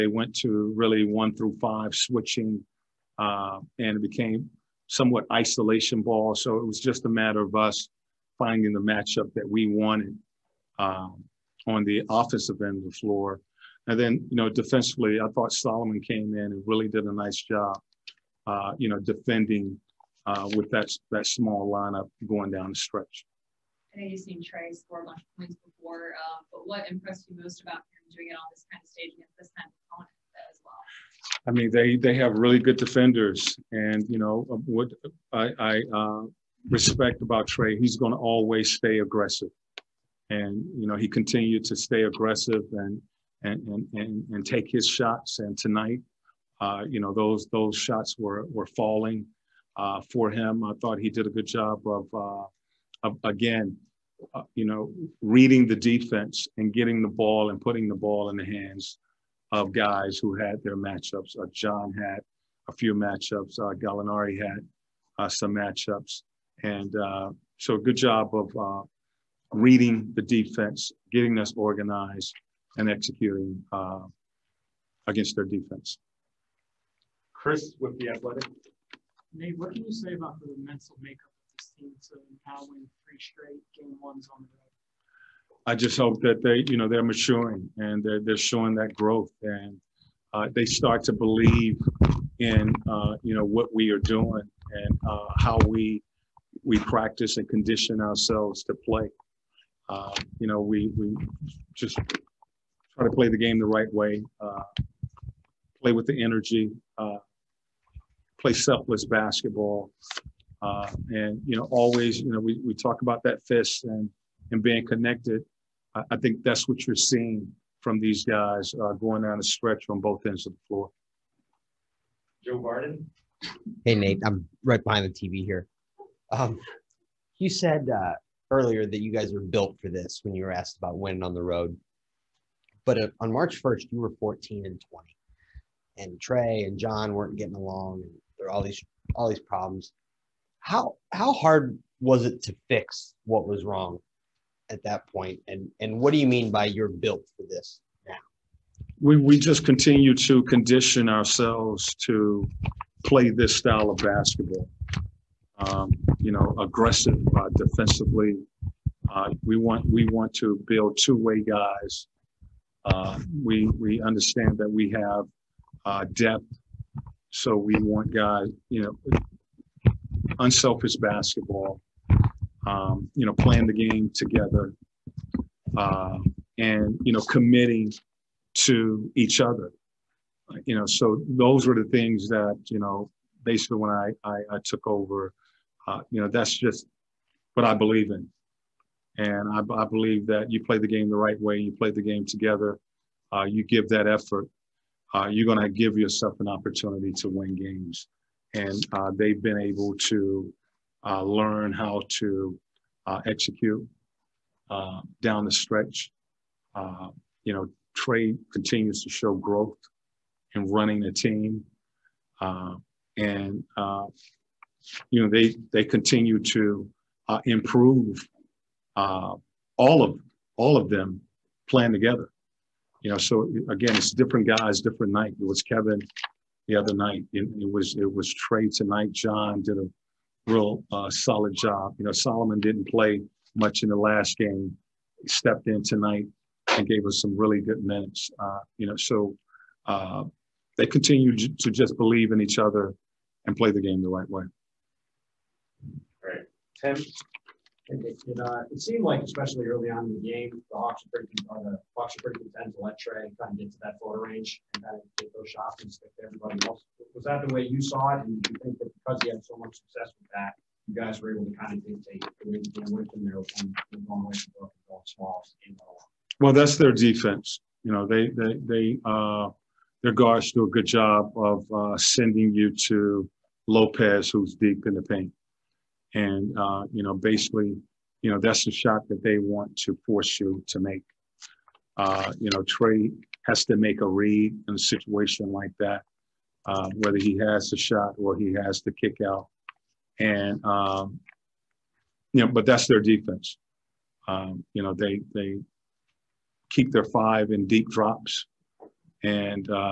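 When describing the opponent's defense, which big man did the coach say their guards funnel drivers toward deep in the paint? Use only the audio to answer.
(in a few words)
Lopez.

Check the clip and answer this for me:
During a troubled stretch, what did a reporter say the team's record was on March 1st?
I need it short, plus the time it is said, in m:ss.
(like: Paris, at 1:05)
14 and 20, at 2:14.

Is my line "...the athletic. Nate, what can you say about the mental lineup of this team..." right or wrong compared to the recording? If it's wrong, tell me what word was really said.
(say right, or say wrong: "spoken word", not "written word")
wrong: "makeup", not "lineup".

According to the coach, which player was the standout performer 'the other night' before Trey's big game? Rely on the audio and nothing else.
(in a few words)
Kevin.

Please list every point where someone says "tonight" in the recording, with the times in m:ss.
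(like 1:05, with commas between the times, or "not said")
0:45, 3:48, 3:55.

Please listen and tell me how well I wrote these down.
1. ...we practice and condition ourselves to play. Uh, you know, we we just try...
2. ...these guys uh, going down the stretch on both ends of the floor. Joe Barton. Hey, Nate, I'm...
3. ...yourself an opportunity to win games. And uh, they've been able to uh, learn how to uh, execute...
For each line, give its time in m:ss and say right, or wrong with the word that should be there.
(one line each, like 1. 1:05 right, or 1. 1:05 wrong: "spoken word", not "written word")
1. 1:36 right
2. 1:57 right
3. 3:15 right.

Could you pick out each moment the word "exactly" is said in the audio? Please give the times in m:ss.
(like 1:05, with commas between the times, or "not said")
not said.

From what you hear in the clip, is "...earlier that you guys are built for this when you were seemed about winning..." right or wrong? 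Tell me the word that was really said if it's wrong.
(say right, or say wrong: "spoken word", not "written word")
wrong: "asked", not "seemed".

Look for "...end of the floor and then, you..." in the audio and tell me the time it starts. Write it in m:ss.
0:12.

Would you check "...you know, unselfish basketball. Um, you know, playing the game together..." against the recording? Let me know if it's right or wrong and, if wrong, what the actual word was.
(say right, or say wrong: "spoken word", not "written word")
right.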